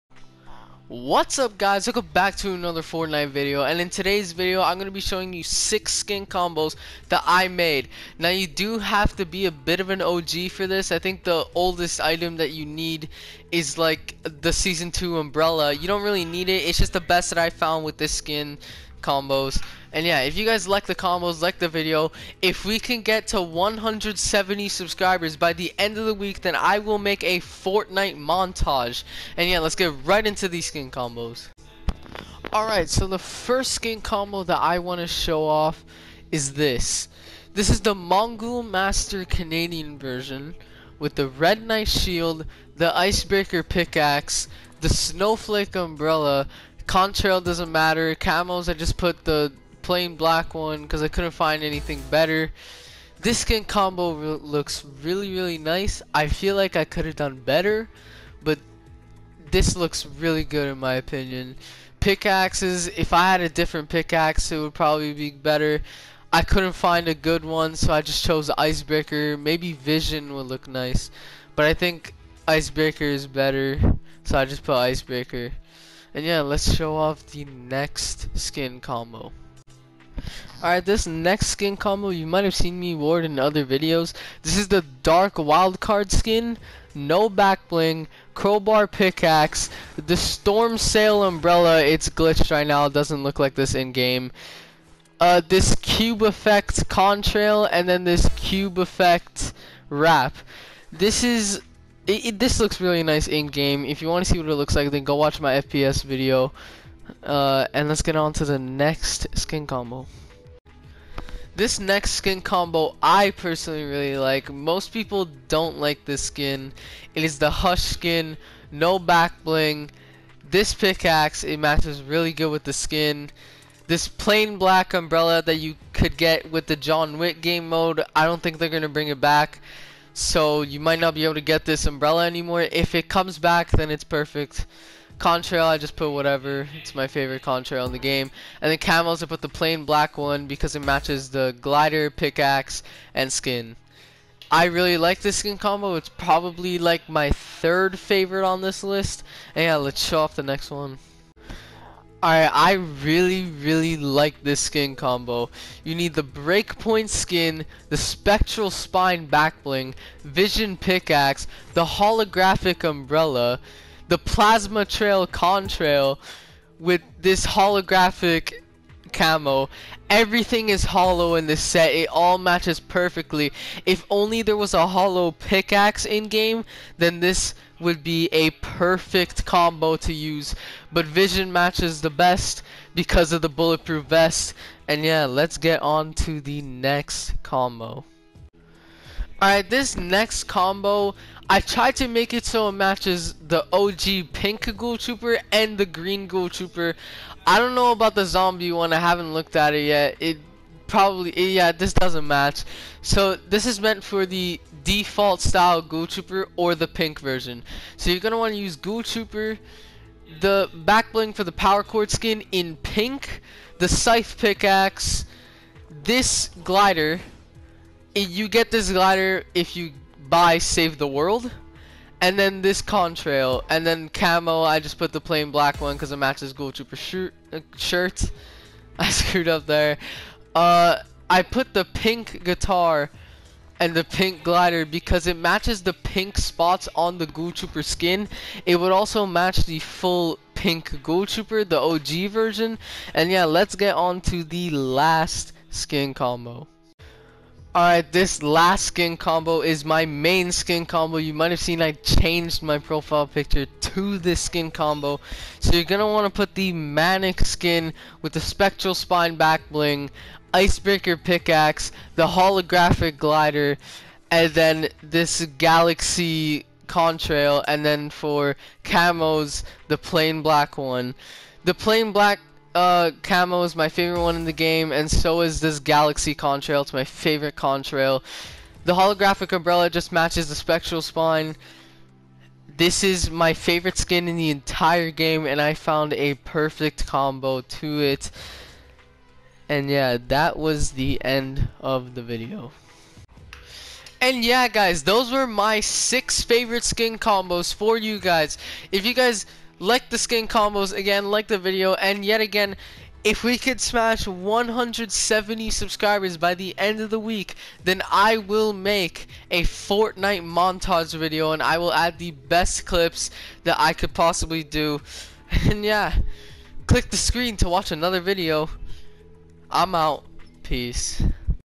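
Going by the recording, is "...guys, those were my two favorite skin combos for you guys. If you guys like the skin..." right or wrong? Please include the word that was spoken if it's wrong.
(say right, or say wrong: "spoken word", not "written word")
wrong: "six", not "two".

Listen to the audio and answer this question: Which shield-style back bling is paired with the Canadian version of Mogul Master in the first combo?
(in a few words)
Red Knight Shield.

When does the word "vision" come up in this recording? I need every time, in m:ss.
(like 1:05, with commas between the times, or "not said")
1:09, 2:40, 3:01.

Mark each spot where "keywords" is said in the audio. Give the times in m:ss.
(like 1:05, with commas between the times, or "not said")
not said.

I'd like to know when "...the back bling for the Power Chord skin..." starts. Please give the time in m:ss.
3:30.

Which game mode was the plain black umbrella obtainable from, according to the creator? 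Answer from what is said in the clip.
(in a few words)
John Wick.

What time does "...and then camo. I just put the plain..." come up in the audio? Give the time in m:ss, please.
3:43.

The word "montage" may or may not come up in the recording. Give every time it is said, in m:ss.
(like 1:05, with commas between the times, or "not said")
0:28, 5:10.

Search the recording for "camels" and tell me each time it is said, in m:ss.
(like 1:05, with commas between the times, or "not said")
2:18.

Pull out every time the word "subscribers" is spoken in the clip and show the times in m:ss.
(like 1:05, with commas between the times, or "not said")
0:24, 5:05.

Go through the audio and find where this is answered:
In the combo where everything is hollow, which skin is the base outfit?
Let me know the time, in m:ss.
2:36.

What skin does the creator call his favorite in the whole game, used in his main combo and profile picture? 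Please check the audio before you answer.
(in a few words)
Manic.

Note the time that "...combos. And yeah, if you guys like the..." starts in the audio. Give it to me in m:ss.
0:19.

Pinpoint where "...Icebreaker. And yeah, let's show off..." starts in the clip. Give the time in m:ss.
1:14.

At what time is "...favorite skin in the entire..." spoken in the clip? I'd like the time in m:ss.
4:43.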